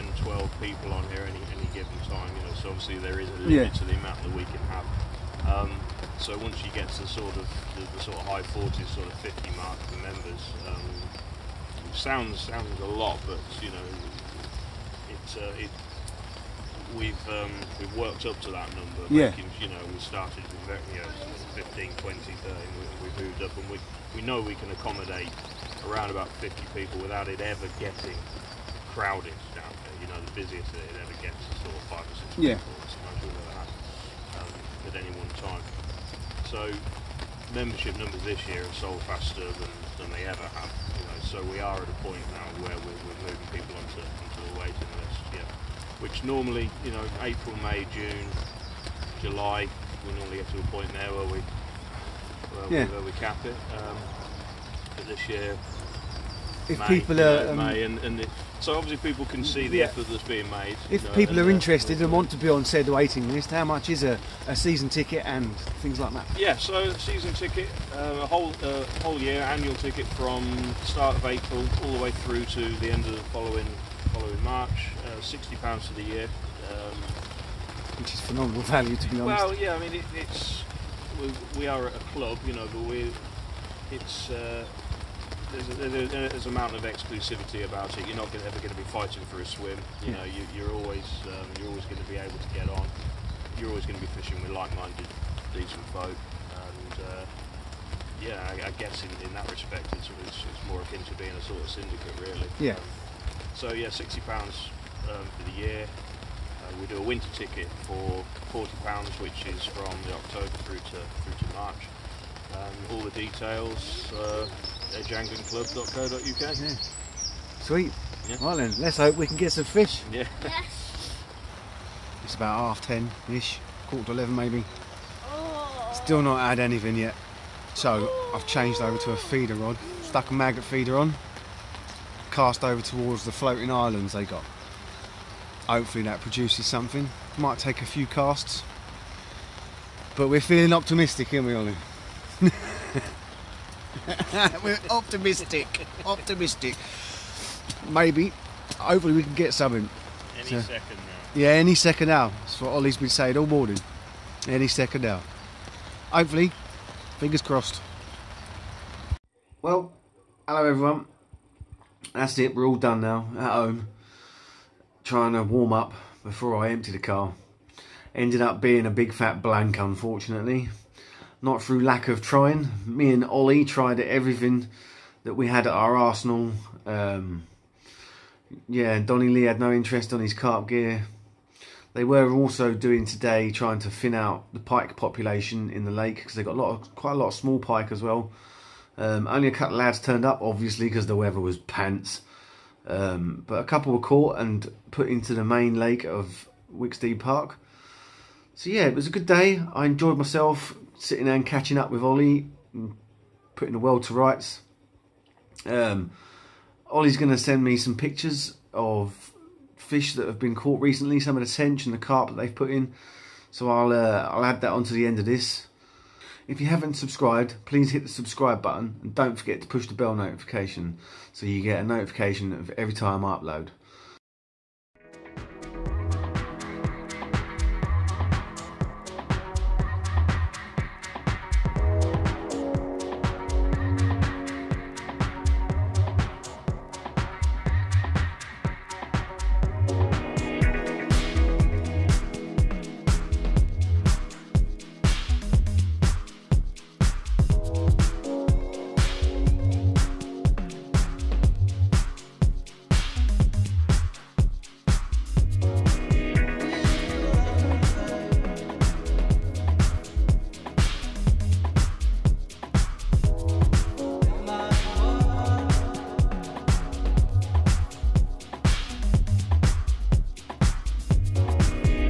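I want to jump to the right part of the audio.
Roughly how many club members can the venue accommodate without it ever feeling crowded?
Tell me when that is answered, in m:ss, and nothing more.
0:25.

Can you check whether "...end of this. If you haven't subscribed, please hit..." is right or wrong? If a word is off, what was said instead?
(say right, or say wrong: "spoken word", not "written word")
right.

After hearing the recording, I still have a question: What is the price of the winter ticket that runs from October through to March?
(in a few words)
£40.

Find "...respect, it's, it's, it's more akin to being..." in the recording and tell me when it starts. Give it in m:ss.
1:39.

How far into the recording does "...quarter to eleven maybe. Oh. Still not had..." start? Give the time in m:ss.
2:03.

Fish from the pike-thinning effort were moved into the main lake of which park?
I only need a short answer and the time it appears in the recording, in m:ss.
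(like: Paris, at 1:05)
Wicksteed Park, at 3:16.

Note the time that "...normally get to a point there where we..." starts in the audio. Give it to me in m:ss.
0:50.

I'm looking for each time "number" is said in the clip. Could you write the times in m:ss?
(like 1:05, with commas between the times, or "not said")
0:18, 0:37.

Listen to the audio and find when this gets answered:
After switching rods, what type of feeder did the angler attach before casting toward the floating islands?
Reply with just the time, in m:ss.
2:10.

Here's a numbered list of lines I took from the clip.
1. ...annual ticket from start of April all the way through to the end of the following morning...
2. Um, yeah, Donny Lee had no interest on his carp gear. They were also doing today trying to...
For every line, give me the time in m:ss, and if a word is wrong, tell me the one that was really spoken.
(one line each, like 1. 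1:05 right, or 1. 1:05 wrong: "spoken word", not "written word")
1. 1:09 wrong: "following", not "morning"
2. 2:56 right.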